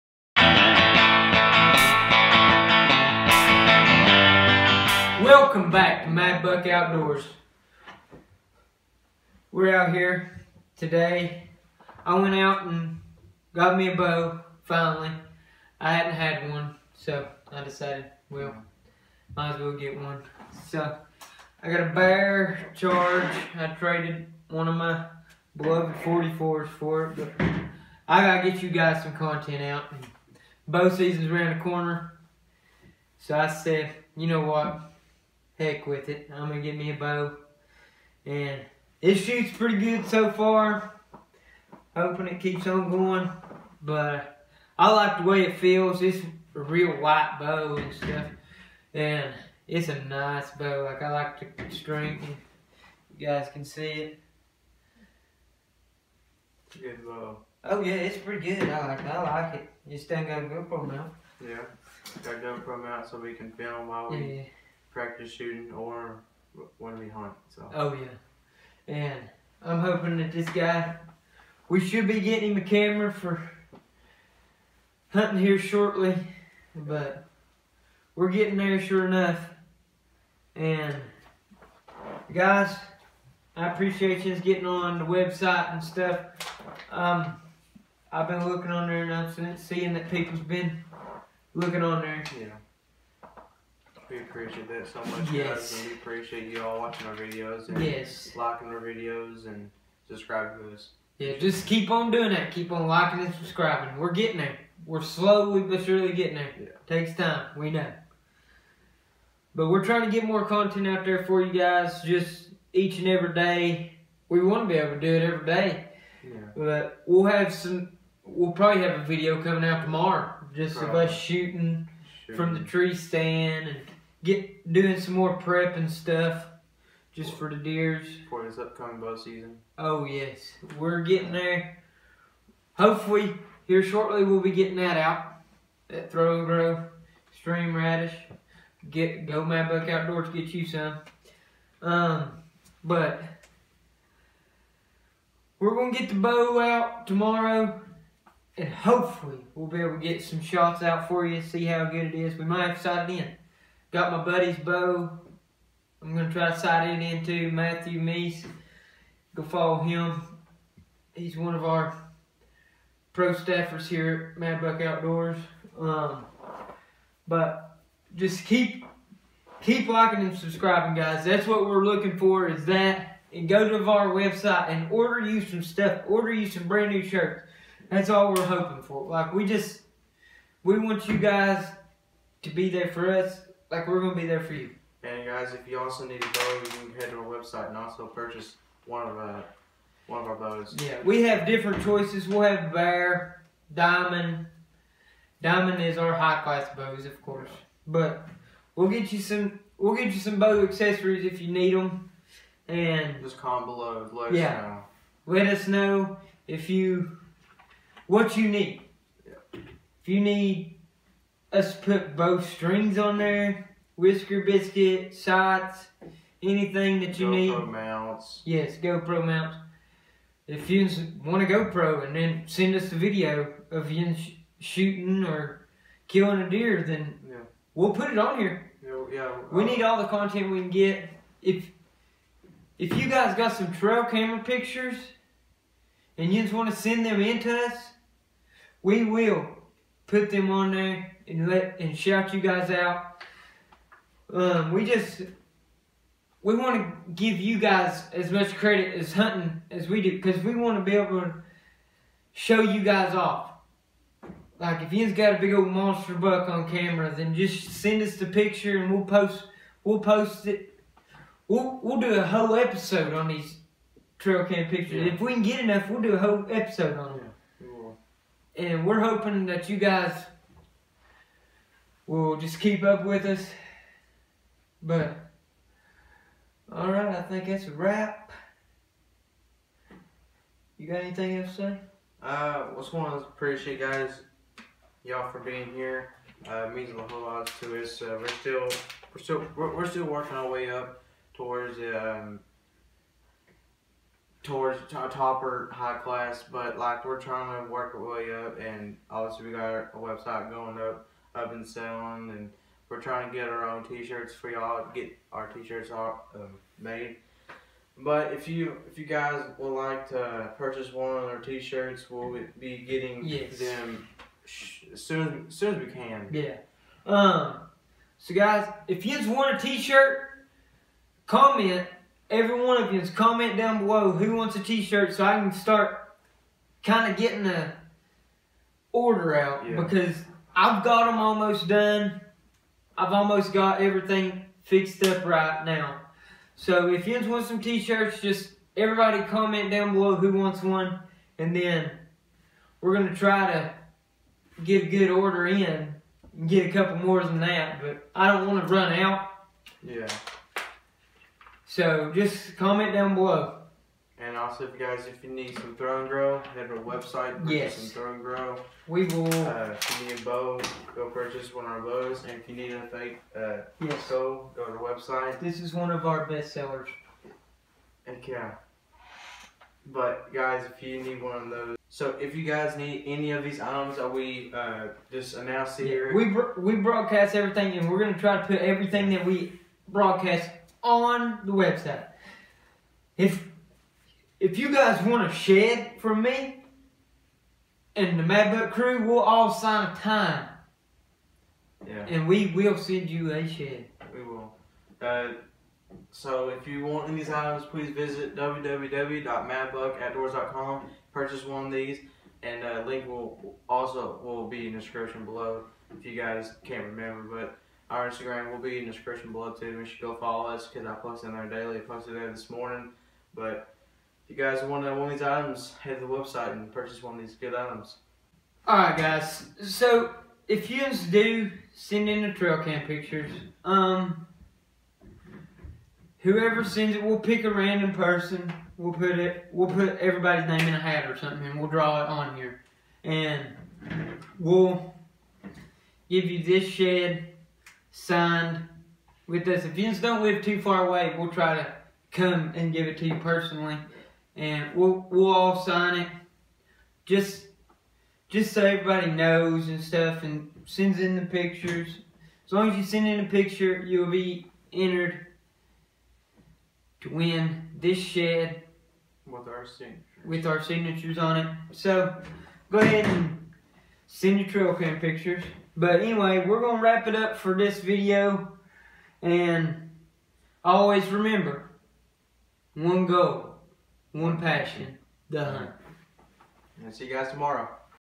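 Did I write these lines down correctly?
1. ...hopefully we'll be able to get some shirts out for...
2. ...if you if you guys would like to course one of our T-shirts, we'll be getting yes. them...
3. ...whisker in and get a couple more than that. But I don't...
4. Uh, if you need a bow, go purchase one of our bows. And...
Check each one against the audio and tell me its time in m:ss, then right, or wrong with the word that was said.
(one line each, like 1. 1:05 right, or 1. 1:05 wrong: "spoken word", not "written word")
1. 2:28 wrong: "shots", not "shirts"
2. 5:08 wrong: "purchase", not "course"
3. 5:45 wrong: "order", not "whisker"
4. 5:59 right.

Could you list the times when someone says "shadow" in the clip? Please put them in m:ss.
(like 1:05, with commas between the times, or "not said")
not said.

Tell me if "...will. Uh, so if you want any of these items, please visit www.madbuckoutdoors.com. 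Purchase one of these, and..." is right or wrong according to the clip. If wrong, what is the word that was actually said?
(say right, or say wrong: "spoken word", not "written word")
right.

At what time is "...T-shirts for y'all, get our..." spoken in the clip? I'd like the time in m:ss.
5:03.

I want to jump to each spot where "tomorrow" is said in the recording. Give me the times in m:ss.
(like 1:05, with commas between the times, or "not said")
1:59, 2:27, 7:57.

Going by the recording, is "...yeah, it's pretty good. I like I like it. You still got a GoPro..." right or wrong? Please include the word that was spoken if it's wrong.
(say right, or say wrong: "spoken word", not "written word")
right.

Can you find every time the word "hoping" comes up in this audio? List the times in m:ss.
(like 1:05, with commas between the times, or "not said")
0:41, 1:09, 2:58, 4:28.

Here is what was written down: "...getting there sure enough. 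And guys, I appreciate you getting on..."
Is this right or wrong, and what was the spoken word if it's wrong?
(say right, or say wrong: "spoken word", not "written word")
right.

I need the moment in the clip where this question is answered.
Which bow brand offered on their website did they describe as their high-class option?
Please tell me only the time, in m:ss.
3:15.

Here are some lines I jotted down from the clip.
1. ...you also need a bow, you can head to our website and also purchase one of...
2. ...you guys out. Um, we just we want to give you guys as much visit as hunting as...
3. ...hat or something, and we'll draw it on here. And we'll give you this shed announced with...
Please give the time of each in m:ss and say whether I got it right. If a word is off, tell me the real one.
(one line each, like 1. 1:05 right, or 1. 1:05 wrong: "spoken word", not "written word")
1. 3:05 right
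2. 4:02 wrong: "credit", not "visit"
3. 7:10 wrong: "signed", not "announced".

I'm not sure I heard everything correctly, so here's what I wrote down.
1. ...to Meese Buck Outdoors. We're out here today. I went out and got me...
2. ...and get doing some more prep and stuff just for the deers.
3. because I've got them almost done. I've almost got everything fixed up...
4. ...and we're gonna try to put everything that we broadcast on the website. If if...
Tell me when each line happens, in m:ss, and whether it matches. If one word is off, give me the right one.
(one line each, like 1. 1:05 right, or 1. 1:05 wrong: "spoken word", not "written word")
1. 0:06 wrong: "Mad", not "Meese"
2. 2:03 right
3. 5:29 right
4. 6:17 right.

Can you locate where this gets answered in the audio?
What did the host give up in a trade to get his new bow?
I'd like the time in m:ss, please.
0:24.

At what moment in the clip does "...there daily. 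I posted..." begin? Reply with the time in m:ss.
6:51.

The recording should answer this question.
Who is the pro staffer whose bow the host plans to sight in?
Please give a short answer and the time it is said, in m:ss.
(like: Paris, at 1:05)
Matthew Meese, at 2:37.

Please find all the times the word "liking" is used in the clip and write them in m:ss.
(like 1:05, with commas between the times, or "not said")
1:38, 1:42, 2:49.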